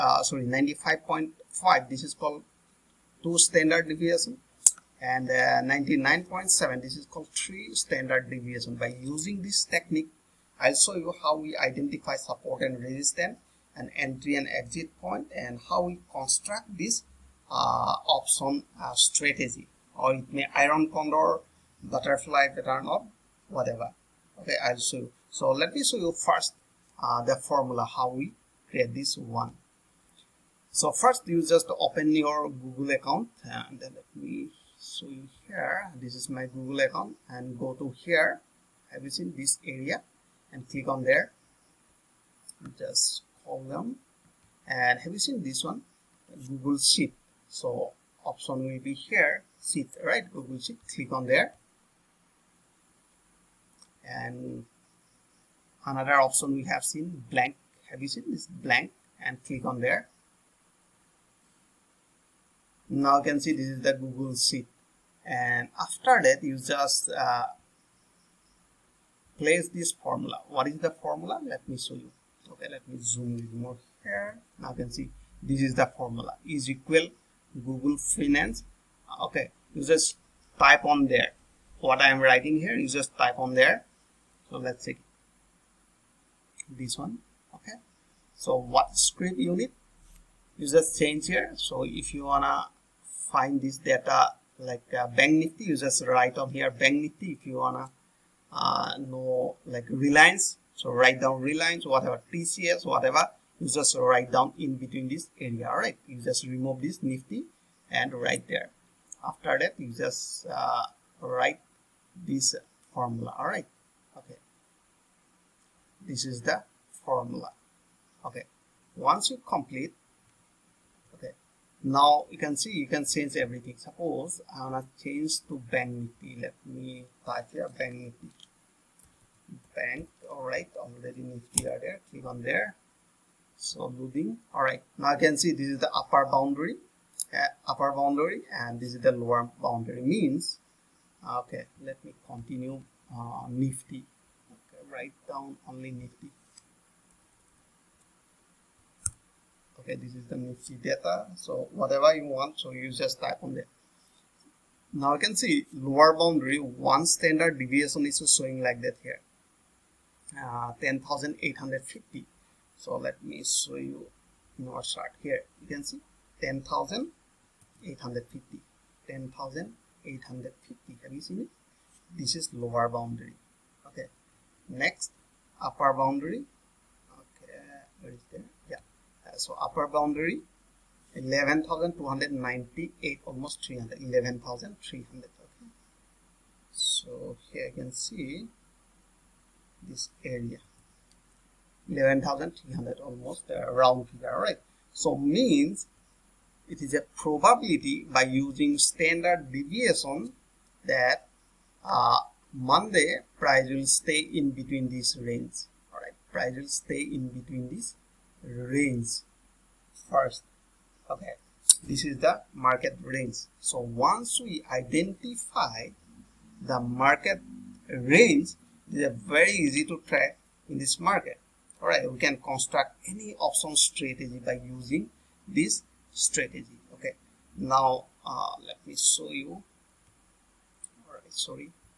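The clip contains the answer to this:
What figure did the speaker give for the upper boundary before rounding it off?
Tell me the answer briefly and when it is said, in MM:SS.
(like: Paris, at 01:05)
11,298, at 03:01.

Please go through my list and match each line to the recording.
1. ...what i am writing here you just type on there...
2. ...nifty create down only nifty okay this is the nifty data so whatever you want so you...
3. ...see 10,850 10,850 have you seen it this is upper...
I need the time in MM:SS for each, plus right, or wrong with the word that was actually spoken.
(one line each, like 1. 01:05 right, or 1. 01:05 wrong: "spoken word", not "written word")
1. 01:21 right
2. 02:23 wrong: "write", not "create"
3. 02:45 wrong: "lower", not "upper".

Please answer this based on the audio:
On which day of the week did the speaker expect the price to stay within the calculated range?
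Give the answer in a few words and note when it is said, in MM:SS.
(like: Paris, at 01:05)
Monday, at 03:22.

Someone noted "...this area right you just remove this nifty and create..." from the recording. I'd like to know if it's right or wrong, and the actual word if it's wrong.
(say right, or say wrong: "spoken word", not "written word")
wrong: "write", not "create".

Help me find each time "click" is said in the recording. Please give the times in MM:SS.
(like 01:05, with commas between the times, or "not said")
00:40, 00:50, 00:59, 02:12.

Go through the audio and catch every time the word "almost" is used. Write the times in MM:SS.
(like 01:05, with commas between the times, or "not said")
03:03, 03:12.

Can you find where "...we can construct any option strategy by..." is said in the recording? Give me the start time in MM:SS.
03:42.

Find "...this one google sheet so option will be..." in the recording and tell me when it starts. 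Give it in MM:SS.
00:45.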